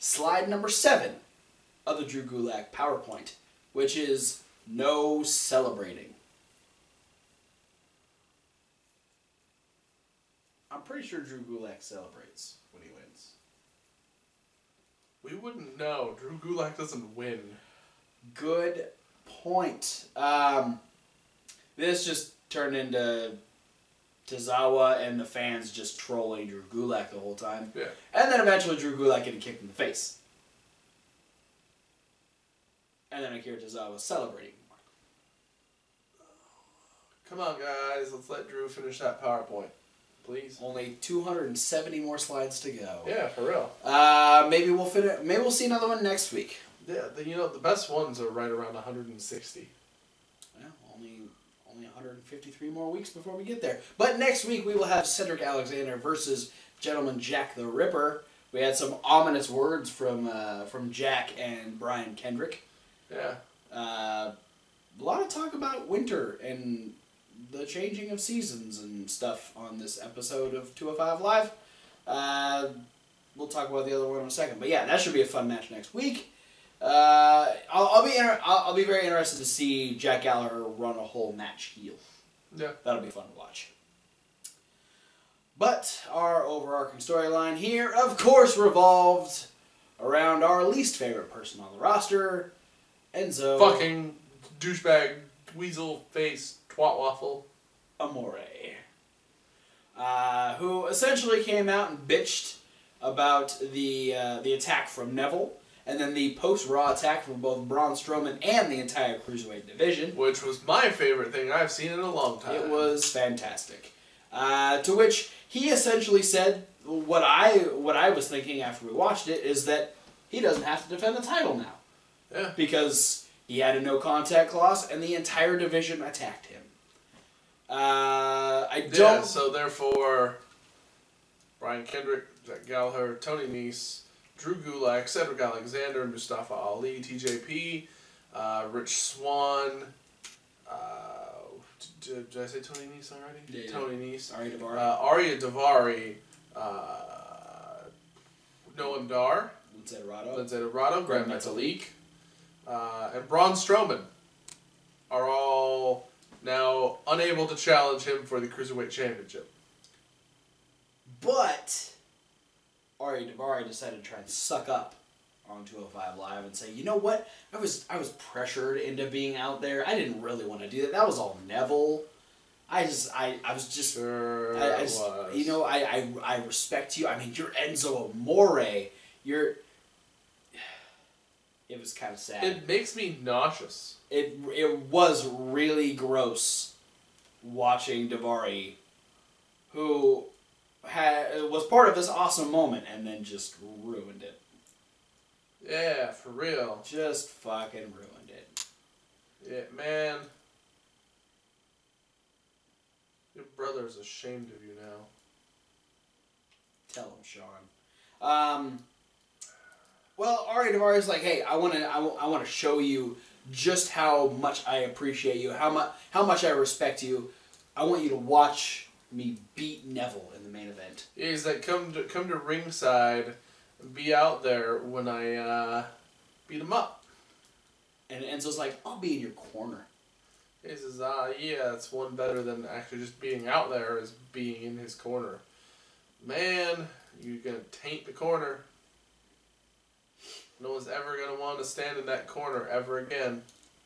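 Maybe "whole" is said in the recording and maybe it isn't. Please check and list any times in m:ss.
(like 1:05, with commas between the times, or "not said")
0:27, 1:21.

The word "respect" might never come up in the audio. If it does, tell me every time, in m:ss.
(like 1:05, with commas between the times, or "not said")
2:56, 3:36.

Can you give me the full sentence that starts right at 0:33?
And then Akira Tozawa celebrating Come on, guys.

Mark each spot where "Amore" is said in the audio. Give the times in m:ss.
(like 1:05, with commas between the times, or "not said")
1:37, 2:58.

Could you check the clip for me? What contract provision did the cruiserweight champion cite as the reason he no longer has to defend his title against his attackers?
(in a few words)
no contact clause.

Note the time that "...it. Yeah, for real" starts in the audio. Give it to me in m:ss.
3:14.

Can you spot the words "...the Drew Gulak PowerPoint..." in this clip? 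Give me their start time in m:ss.
0:01.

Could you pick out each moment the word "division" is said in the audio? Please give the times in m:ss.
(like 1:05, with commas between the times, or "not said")
1:49, 2:05.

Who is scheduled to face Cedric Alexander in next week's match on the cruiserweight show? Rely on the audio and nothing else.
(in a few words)
Gentleman Jack the Ripper.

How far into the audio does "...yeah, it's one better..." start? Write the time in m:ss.
3:51.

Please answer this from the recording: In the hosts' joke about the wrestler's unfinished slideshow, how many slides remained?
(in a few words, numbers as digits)
270.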